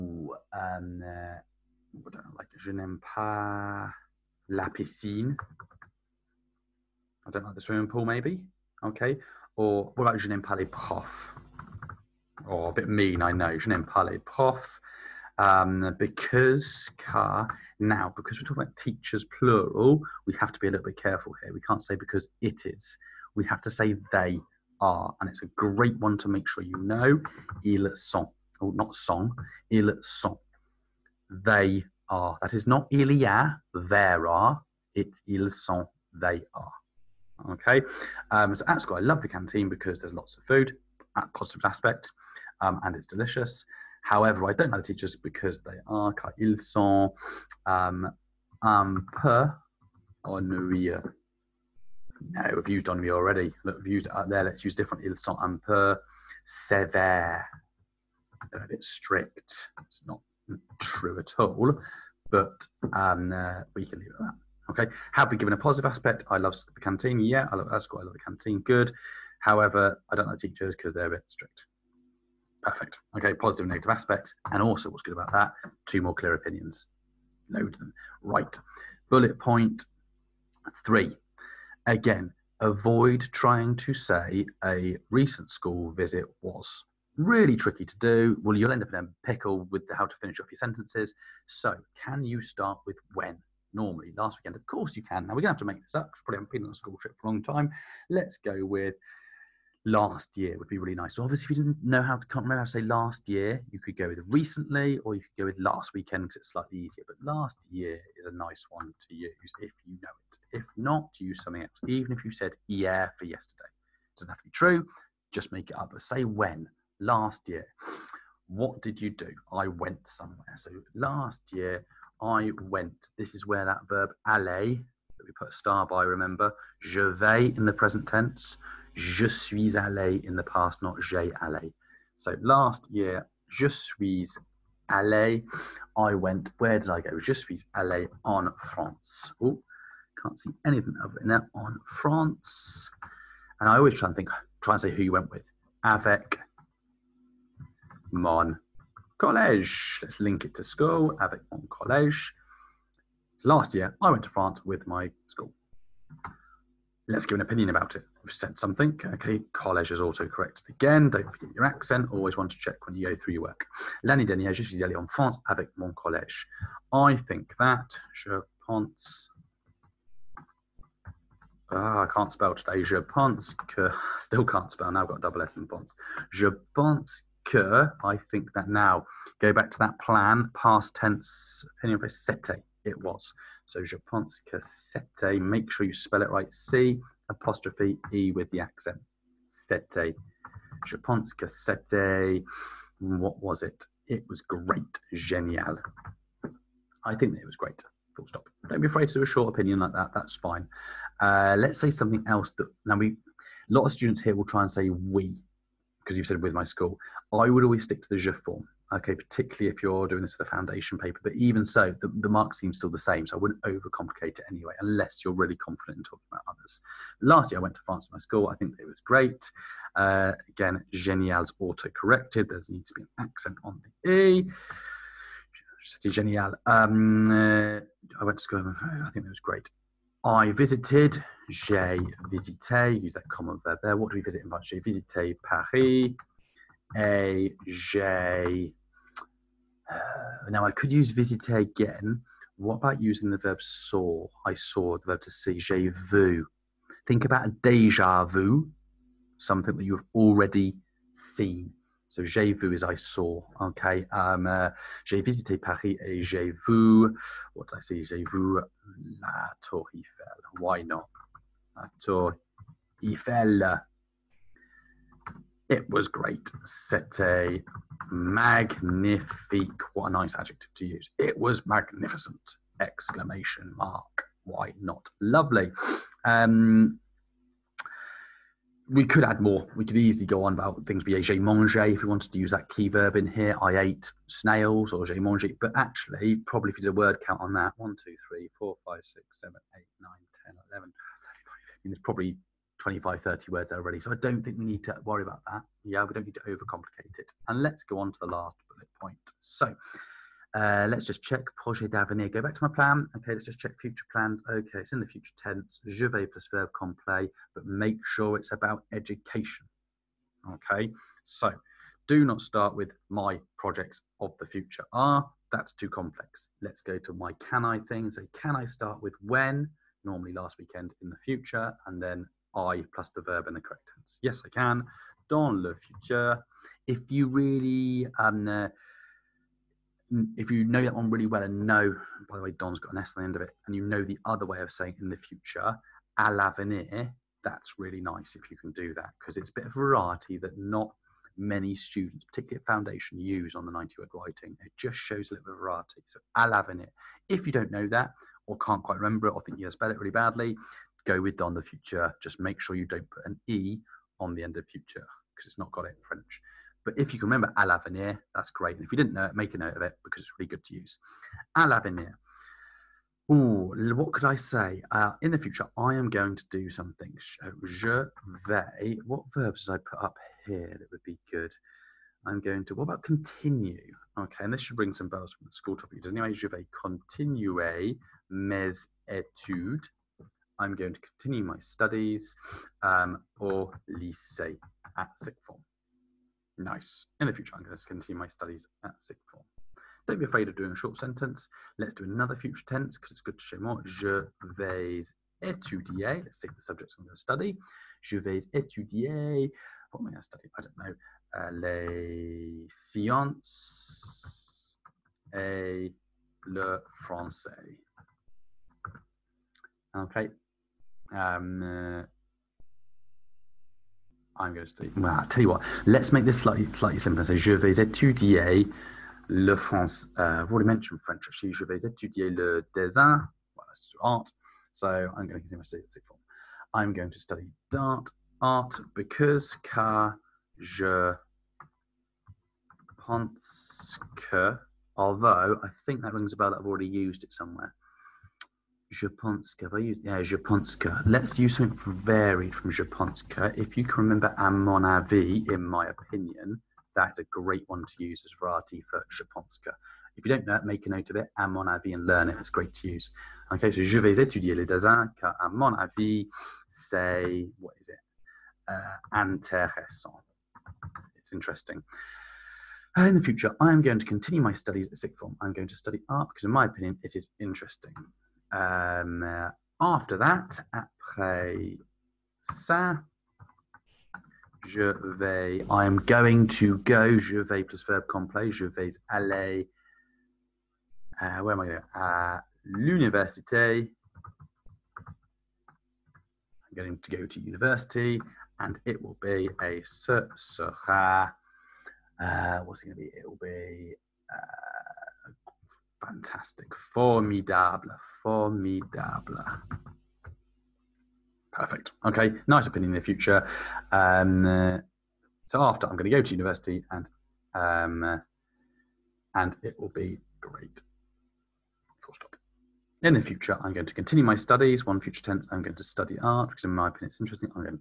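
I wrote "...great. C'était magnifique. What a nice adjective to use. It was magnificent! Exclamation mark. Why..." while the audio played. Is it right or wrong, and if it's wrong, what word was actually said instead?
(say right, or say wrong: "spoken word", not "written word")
right.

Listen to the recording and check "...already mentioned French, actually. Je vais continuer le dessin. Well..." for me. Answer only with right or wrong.
wrong.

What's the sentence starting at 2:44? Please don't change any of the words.
L'année dernière, je suis allé en France avec mon collège.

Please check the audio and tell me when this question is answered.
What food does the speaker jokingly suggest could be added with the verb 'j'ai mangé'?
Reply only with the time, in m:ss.
4:44.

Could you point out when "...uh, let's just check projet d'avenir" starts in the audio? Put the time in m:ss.
5:00.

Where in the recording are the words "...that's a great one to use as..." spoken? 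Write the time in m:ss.
7:26.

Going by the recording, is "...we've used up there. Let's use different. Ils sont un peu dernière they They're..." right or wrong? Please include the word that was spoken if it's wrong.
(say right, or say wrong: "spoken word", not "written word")
wrong: "severe", not "dernière".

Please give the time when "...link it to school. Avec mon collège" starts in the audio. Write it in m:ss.
2:30.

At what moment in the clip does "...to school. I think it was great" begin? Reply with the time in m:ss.
3:48.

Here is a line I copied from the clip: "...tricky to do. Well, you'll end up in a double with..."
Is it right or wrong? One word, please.
wrong.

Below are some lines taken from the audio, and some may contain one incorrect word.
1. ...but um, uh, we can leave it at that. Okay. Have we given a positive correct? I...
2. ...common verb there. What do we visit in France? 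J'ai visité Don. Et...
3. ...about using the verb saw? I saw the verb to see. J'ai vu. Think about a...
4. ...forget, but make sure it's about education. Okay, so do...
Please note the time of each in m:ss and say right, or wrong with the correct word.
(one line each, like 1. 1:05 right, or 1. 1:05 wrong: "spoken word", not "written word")
1. 1:02 wrong: "aspect", not "correct"
2. 3:53 wrong: "Paris", not "Don"
3. 4:02 right
4. 5:06 wrong: "complet", not "forget".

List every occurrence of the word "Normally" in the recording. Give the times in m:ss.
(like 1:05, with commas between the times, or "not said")
1:33, 5:20.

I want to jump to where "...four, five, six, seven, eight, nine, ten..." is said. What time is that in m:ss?
4:48.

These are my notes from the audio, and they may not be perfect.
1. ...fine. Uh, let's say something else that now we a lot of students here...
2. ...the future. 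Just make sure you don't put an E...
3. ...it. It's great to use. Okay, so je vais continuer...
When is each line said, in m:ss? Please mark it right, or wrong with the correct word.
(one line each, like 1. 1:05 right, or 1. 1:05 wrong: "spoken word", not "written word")
1. 3:20 right
2. 5:51 right
3. 7:32 wrong: "étudier", not "continuer".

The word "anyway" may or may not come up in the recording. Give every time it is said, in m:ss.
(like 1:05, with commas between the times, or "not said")
3:34, 6:16.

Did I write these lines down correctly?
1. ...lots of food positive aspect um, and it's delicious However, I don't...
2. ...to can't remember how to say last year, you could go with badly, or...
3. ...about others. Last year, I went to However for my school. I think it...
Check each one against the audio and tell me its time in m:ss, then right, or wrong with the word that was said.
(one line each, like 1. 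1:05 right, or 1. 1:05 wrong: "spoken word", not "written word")
1. 0:40 right
2. 1:42 wrong: "recently", not "badly"
3. 3:36 wrong: "France", not "However".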